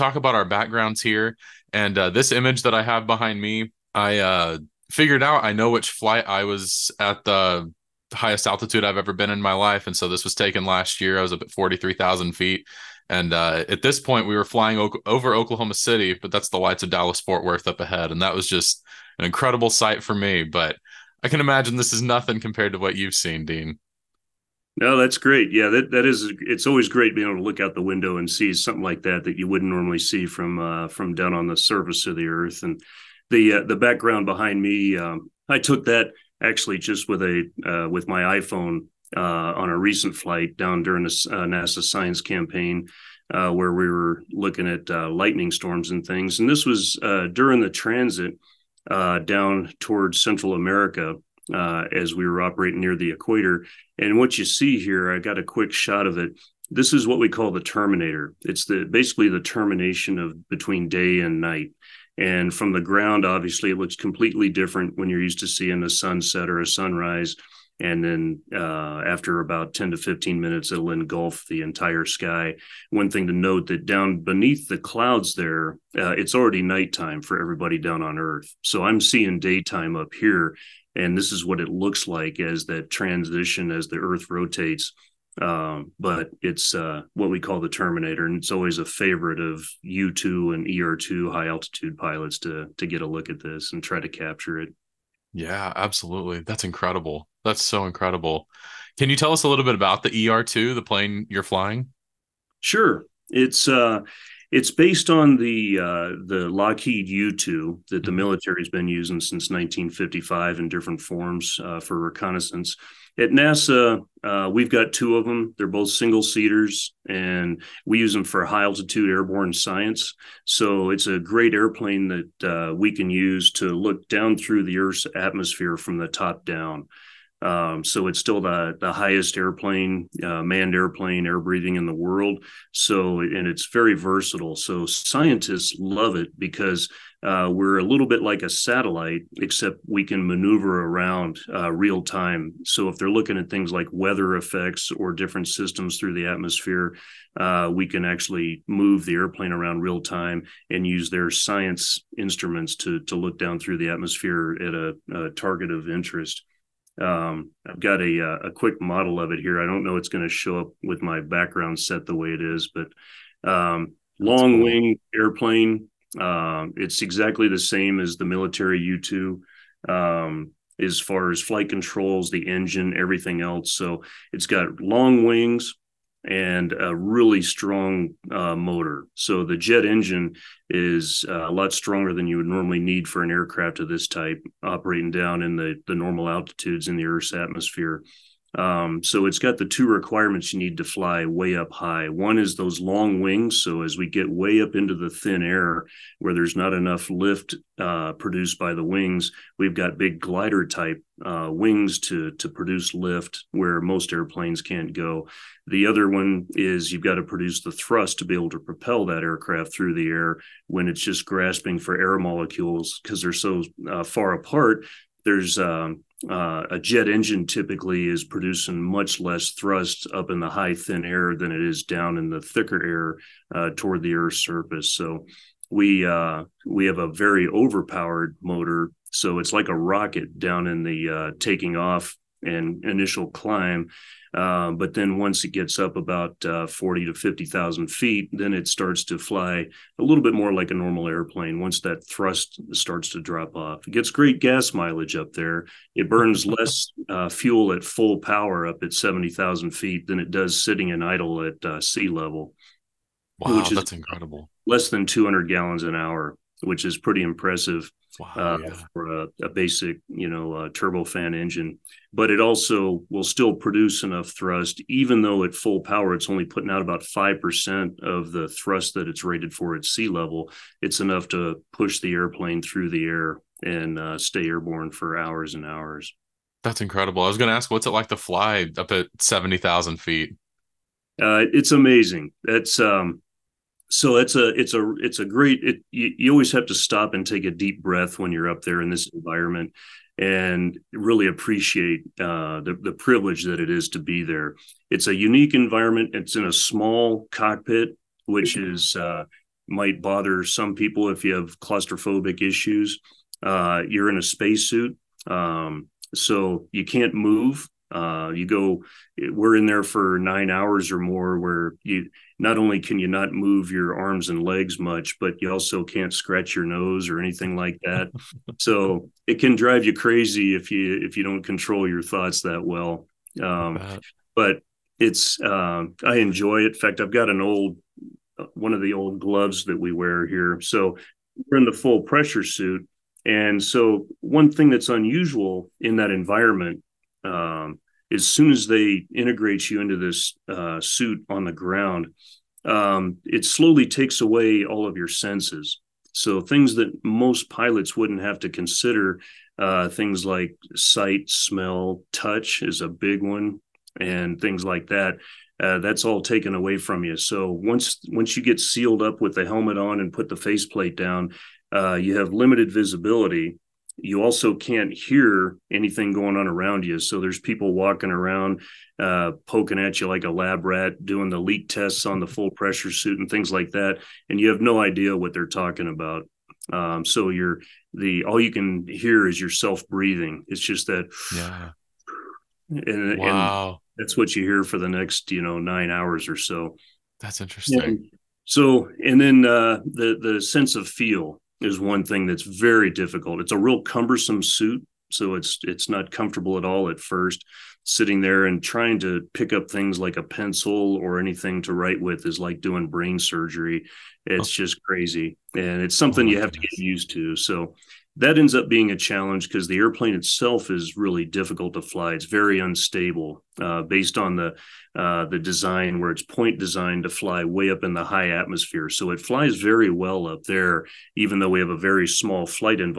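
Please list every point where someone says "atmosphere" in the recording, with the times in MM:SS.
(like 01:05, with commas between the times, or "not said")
02:05, 02:26, 02:33, 03:07, 06:58.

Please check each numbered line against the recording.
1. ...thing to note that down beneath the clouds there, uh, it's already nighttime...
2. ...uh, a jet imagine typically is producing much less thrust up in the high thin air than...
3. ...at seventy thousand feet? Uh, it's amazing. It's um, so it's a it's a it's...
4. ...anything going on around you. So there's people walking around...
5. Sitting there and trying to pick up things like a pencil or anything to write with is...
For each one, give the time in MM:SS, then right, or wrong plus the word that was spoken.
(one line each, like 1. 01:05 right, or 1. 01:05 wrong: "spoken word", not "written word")
1. 01:13 right
2. 03:36 wrong: "engine", not "imagine"
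3. 04:38 right
4. 06:05 right
5. 06:37 right.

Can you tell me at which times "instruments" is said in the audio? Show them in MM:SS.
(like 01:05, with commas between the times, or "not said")
02:32.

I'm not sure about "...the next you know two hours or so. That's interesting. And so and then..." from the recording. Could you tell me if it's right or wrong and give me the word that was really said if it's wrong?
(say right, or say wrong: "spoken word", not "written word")
wrong: "nine", not "two".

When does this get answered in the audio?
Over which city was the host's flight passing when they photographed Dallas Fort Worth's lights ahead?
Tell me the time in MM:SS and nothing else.
00:15.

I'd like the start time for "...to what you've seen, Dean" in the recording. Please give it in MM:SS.
00:22.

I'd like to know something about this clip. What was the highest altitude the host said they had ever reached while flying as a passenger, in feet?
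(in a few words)
43,000 feet.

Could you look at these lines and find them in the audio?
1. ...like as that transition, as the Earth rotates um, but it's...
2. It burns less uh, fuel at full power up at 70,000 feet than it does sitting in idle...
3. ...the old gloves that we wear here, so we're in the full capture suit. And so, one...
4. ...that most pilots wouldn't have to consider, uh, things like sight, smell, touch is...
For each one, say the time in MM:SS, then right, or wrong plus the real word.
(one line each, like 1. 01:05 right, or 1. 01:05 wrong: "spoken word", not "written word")
1. 01:22 right
2. 04:05 right
3. 05:28 wrong: "pressure", not "capture"
4. 05:46 right.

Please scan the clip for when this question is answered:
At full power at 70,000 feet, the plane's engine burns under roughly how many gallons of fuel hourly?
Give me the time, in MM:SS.
04:15.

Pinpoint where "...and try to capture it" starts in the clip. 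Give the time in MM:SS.
01:33.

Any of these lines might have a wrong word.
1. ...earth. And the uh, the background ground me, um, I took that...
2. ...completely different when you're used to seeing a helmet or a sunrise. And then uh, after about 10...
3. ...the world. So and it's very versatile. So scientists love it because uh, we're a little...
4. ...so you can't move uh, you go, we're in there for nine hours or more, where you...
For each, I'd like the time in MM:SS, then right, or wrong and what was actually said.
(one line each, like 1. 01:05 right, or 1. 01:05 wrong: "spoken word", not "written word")
1. 00:32 wrong: "behind", not "ground"
2. 01:03 wrong: "sunset", not "helmet"
3. 02:11 right
4. 05:06 right.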